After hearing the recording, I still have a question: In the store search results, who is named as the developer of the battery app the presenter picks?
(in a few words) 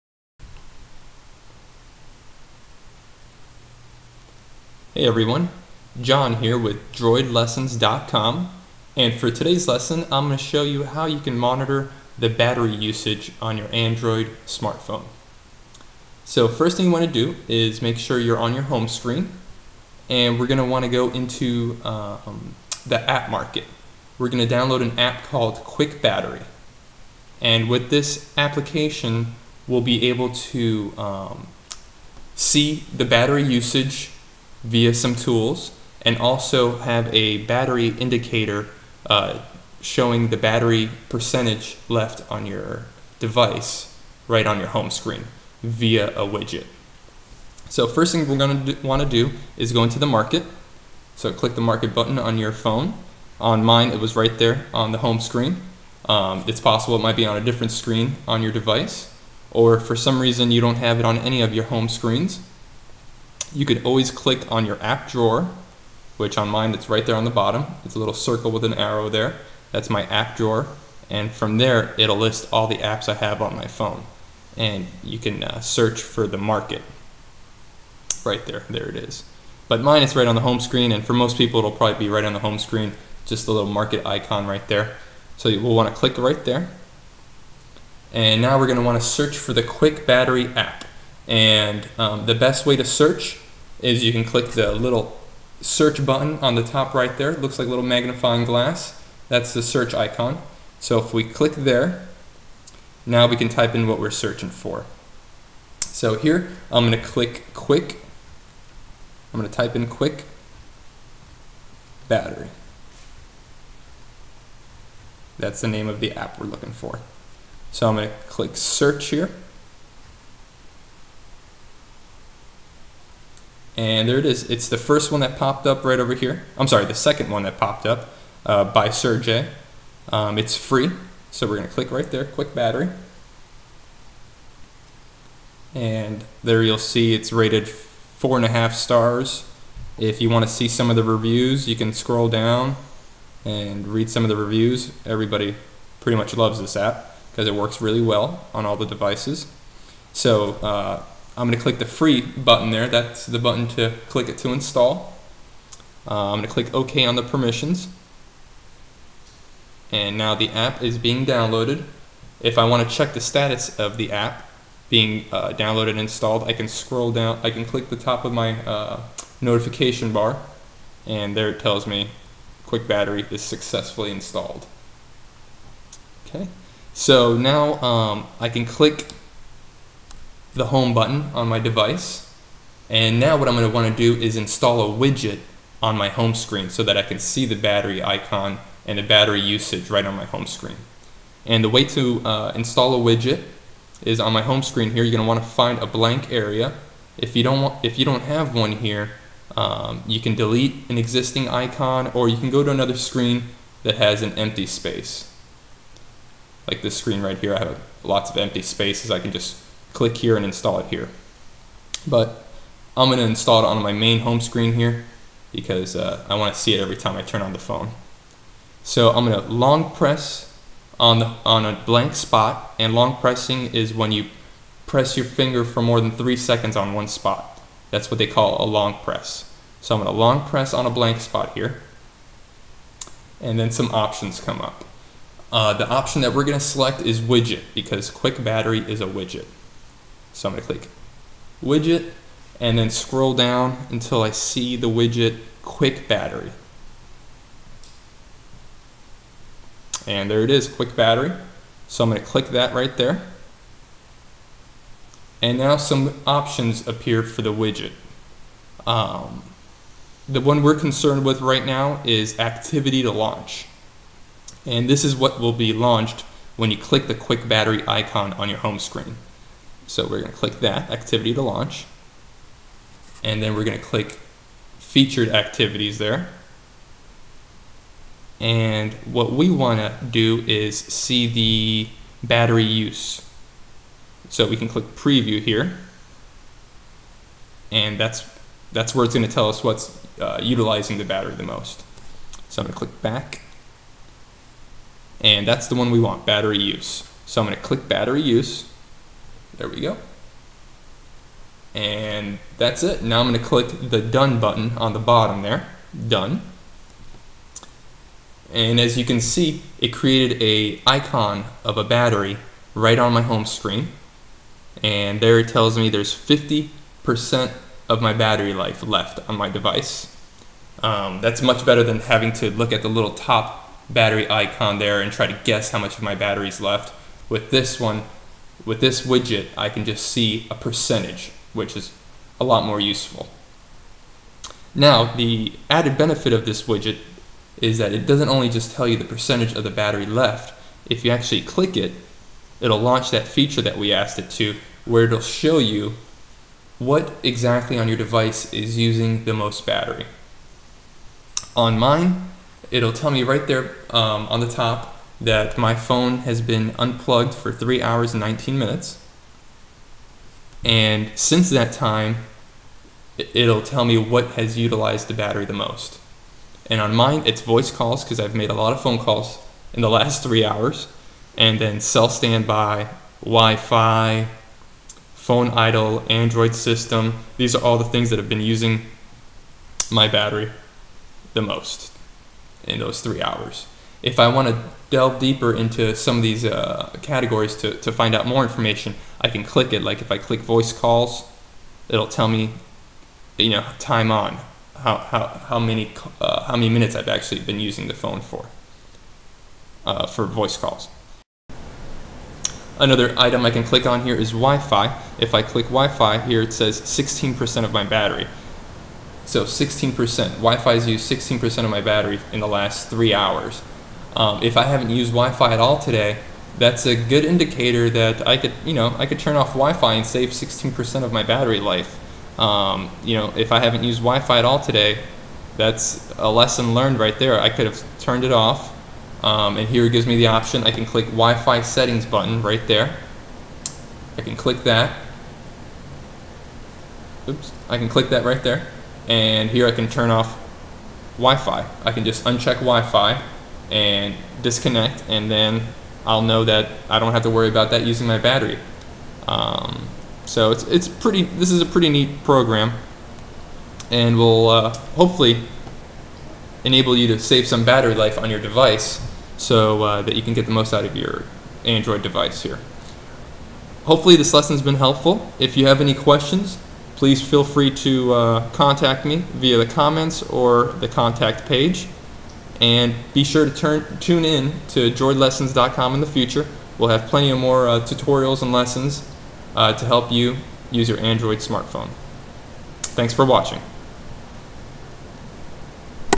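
Sergey.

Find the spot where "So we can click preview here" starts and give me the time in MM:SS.
04:44.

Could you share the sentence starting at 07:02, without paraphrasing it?
Um, you know, if I haven't used Wi-Fi at all today, that's a lesson learned right there.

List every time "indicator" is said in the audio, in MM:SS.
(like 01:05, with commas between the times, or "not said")
00:37, 06:57.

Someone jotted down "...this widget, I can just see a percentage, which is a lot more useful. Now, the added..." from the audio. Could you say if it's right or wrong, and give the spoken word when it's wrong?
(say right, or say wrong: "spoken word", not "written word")
right.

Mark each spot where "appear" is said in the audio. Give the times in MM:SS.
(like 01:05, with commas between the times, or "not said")
04:16.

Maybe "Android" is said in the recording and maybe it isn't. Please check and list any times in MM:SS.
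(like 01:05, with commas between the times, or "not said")
00:13, 06:16, 07:41, 08:00.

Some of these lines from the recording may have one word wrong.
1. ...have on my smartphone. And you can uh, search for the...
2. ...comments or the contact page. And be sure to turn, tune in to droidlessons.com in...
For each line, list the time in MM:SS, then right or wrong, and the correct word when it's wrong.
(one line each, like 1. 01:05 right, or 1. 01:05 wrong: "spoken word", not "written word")
1. 01:13 wrong: "phone", not "smartphone"
2. 07:49 right.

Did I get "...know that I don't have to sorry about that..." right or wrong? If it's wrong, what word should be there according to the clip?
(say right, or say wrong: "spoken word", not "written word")
wrong: "worry", not "sorry".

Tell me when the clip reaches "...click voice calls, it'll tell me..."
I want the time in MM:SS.
06:30.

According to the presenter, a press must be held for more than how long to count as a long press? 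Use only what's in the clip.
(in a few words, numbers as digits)
3 seconds.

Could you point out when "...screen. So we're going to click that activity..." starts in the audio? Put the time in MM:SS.
04:28.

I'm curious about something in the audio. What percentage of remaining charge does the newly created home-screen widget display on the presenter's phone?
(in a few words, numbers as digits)
50%.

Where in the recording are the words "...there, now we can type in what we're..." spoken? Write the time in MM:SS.
01:41.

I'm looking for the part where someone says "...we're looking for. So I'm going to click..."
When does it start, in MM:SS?
01:56.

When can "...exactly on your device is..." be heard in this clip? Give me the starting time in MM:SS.
05:47.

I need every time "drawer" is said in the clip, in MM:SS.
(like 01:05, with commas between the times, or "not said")
01:05, 01:10.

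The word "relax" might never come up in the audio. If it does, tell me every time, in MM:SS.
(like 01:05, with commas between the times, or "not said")
not said.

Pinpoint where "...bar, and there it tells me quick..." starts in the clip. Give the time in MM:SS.
02:50.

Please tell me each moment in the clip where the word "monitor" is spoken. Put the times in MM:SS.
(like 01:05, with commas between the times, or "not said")
00:11.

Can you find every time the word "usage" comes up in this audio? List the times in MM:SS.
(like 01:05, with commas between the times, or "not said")
00:12, 00:33, 03:09.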